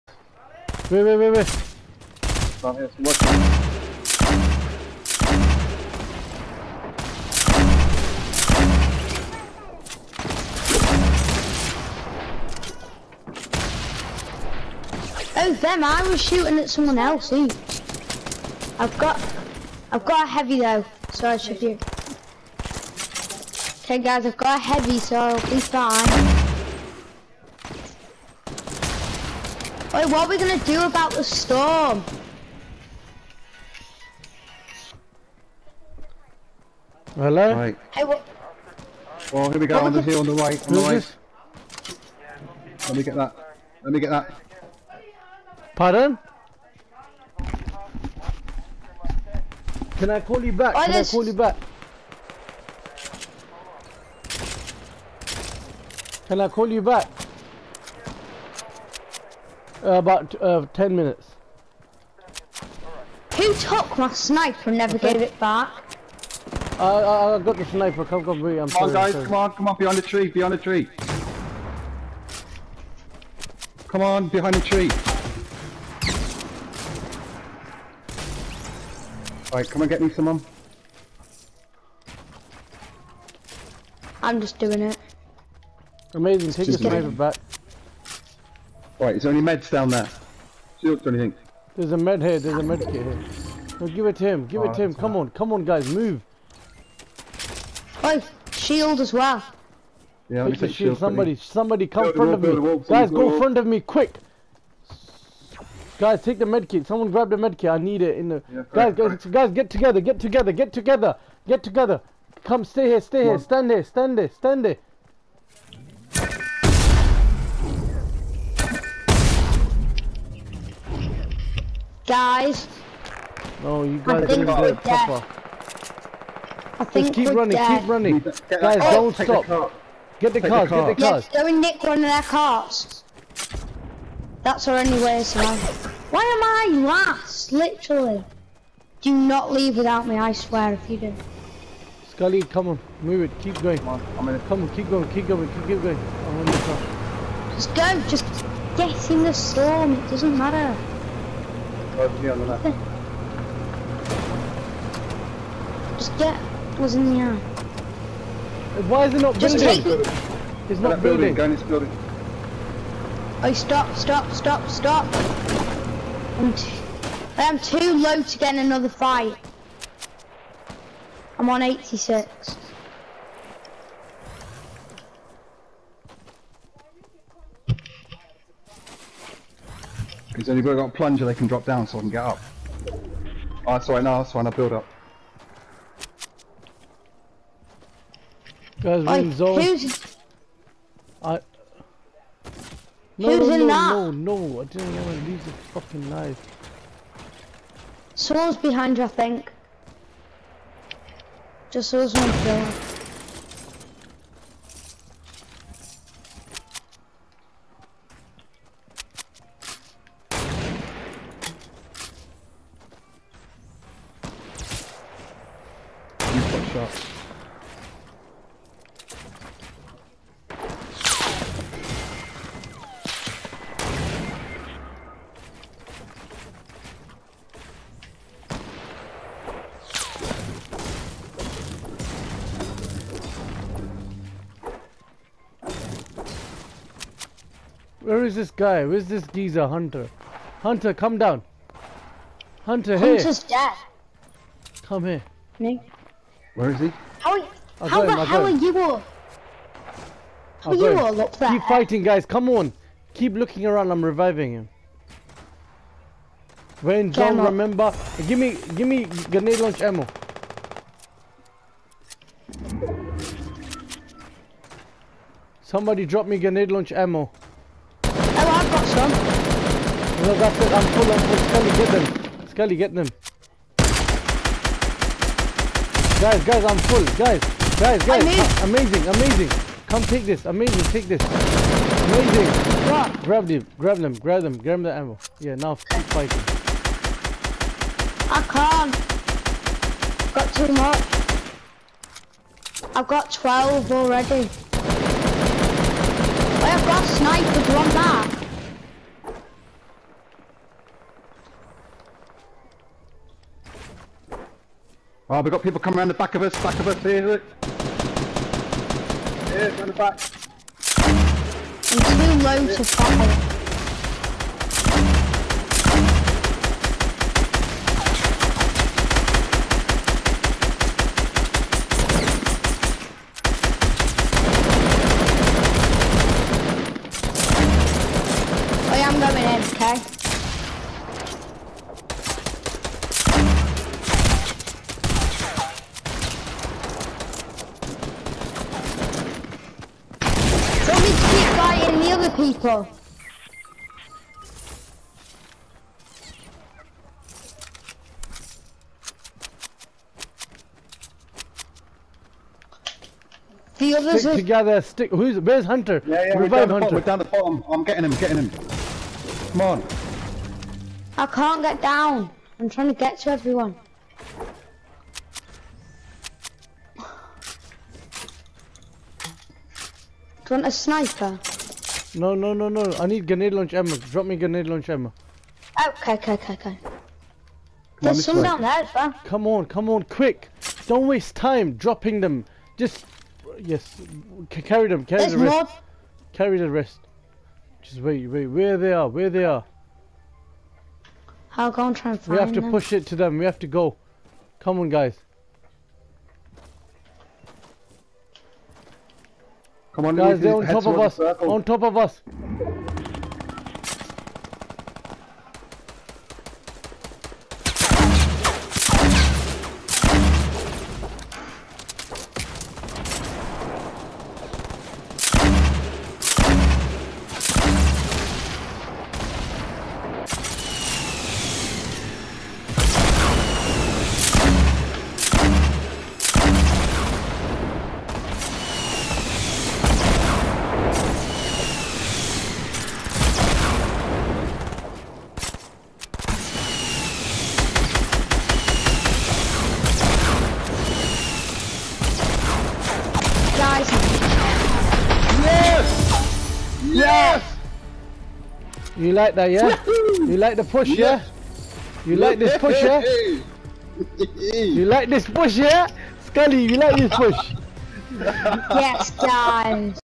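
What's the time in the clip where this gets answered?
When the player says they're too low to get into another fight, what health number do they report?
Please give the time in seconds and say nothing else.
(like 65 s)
171 s.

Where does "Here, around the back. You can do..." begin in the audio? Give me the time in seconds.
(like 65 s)
309 s.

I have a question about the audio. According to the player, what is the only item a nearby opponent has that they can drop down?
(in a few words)
a plunger.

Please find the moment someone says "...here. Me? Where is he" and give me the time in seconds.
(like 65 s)
245 s.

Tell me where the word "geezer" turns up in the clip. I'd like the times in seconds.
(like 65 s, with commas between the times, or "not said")
239 s.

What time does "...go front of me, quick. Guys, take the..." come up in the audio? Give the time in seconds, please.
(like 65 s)
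103 s.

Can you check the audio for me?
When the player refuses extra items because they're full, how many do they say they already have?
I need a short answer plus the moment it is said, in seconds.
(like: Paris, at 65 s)
12, at 292 s.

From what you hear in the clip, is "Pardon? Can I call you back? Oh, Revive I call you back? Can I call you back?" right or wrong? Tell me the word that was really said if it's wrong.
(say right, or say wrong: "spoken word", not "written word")
wrong: "Can", not "Revive".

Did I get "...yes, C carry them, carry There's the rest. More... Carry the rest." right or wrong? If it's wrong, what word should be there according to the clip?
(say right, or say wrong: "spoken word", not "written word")
right.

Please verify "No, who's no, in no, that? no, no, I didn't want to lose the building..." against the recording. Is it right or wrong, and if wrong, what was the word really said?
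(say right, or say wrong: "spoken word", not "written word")
wrong: "fucking", not "building".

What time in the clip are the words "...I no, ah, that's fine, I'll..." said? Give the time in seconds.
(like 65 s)
183 s.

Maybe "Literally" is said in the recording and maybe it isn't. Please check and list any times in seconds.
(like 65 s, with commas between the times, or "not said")
137 s.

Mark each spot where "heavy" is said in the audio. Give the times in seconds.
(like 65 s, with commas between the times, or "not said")
20 s, 24 s.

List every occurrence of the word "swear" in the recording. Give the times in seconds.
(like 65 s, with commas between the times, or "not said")
140 s.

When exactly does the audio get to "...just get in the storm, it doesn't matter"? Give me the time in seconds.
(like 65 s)
148 s.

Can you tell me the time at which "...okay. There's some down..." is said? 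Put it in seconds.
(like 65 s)
376 s.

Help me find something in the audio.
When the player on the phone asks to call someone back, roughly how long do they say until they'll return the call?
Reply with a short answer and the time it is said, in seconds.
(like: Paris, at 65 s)
10 minutes, at 60 s.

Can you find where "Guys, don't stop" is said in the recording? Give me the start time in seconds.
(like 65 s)
128 s.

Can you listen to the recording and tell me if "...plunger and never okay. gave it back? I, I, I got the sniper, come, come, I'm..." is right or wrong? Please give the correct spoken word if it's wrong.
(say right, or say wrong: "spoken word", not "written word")
wrong: "sniper", not "plunger".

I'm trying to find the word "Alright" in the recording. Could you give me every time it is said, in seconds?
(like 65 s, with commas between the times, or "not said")
79 s, 89 s.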